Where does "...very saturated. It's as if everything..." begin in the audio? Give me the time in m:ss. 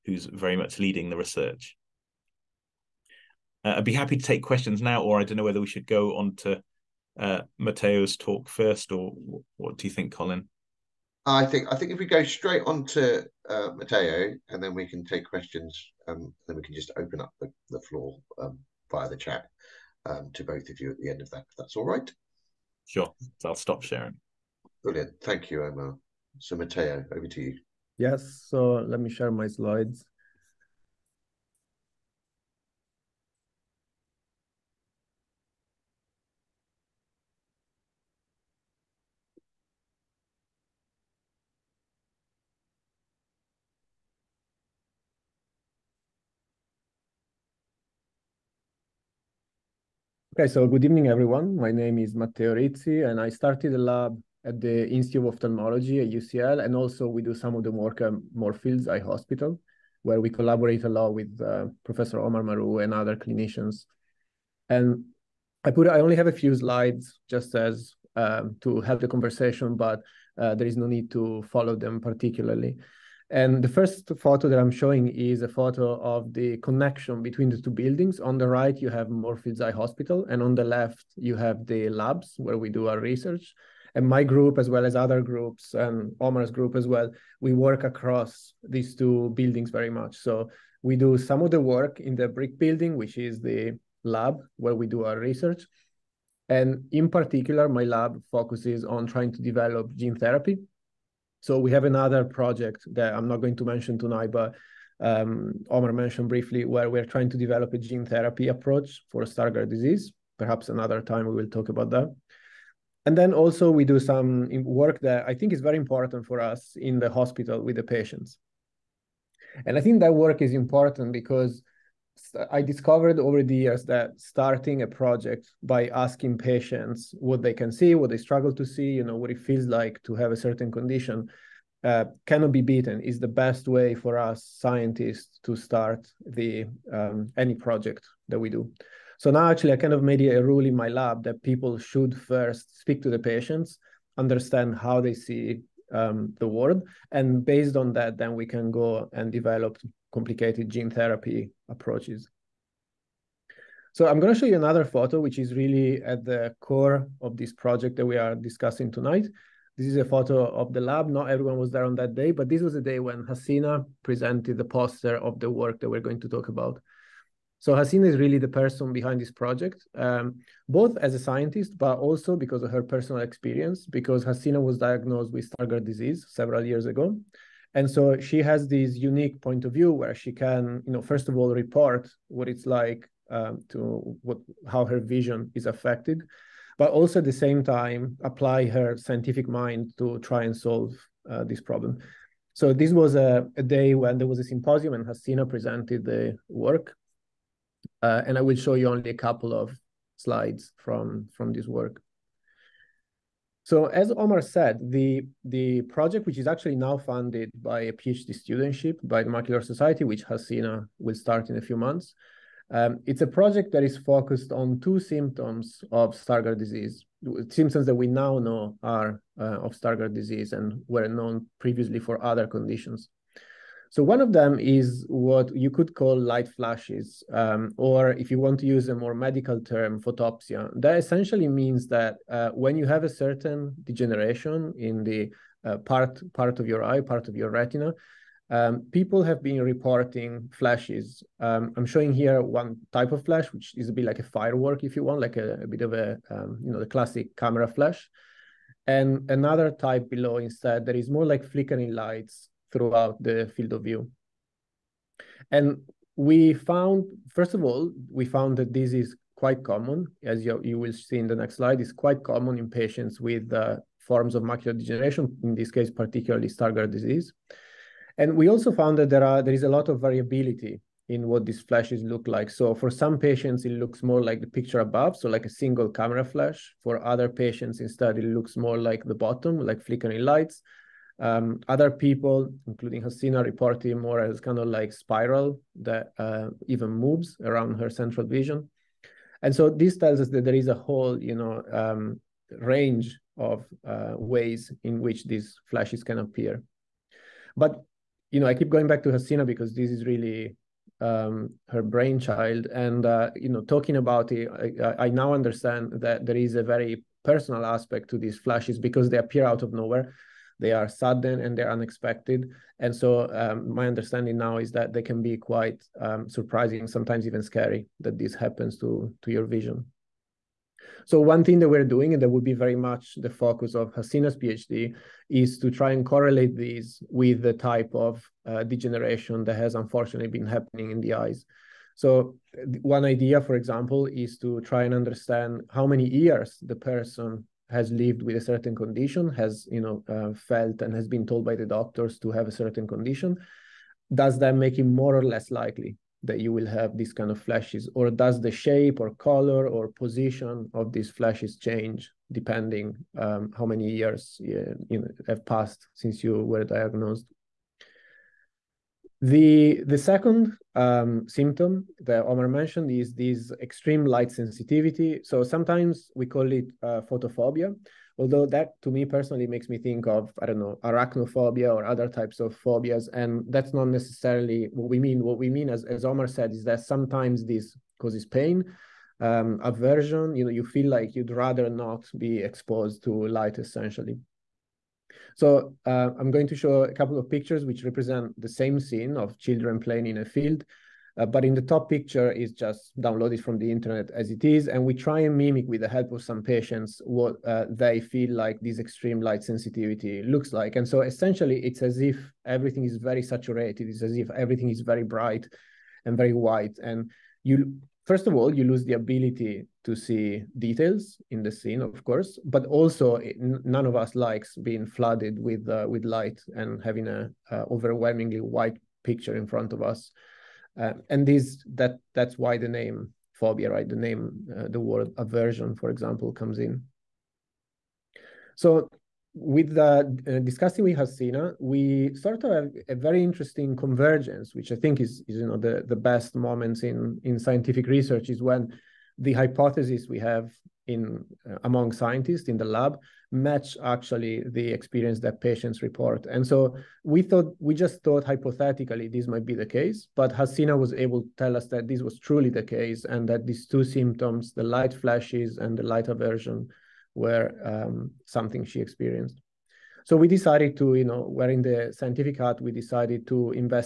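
6:42.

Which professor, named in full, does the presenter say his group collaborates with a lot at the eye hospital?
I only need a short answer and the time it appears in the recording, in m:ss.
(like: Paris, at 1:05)
Omar Mahroo, at 1:02.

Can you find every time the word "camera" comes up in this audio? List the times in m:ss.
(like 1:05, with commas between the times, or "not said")
4:07, 4:35.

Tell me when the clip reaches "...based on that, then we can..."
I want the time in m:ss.
2:27.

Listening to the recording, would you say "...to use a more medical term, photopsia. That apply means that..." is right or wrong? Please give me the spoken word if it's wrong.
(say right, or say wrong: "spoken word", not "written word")
wrong: "essentially", not "apply".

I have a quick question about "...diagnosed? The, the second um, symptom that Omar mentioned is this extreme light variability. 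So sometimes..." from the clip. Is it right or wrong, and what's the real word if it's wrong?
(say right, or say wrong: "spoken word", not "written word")
wrong: "sensitivity", not "variability".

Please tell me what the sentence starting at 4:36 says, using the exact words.
For other patients, instead, it looks more like the bottom, like flickering lights.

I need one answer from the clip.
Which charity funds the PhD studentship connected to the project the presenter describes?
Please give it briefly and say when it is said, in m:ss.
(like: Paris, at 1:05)
Macular Society, at 3:29.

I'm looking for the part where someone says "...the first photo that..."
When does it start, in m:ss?
1:13.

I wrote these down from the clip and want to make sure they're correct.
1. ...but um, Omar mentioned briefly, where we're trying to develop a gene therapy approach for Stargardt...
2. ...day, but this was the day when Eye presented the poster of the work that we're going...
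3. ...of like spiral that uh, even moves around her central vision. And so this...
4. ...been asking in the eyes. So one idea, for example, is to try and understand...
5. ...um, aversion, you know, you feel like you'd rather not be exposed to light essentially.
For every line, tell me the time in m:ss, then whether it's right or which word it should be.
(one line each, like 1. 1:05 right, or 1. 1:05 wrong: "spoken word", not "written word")
1. 1:44 right
2. 2:42 wrong: "Hasina", not "Eye"
3. 4:44 right
4. 5:30 wrong: "happening", not "asking"
5. 6:19 right.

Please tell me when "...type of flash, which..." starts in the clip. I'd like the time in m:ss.
4:02.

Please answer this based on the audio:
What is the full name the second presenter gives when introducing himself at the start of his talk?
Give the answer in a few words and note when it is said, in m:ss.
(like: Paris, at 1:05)
Matteo Rizzi, at 0:52.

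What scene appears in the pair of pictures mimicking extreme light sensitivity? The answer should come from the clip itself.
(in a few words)
children playing in a field.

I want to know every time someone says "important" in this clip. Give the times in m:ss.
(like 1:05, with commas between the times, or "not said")
1:55, 2:00.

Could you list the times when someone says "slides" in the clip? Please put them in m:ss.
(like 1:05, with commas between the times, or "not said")
0:29, 1:06, 3:20, 4:21.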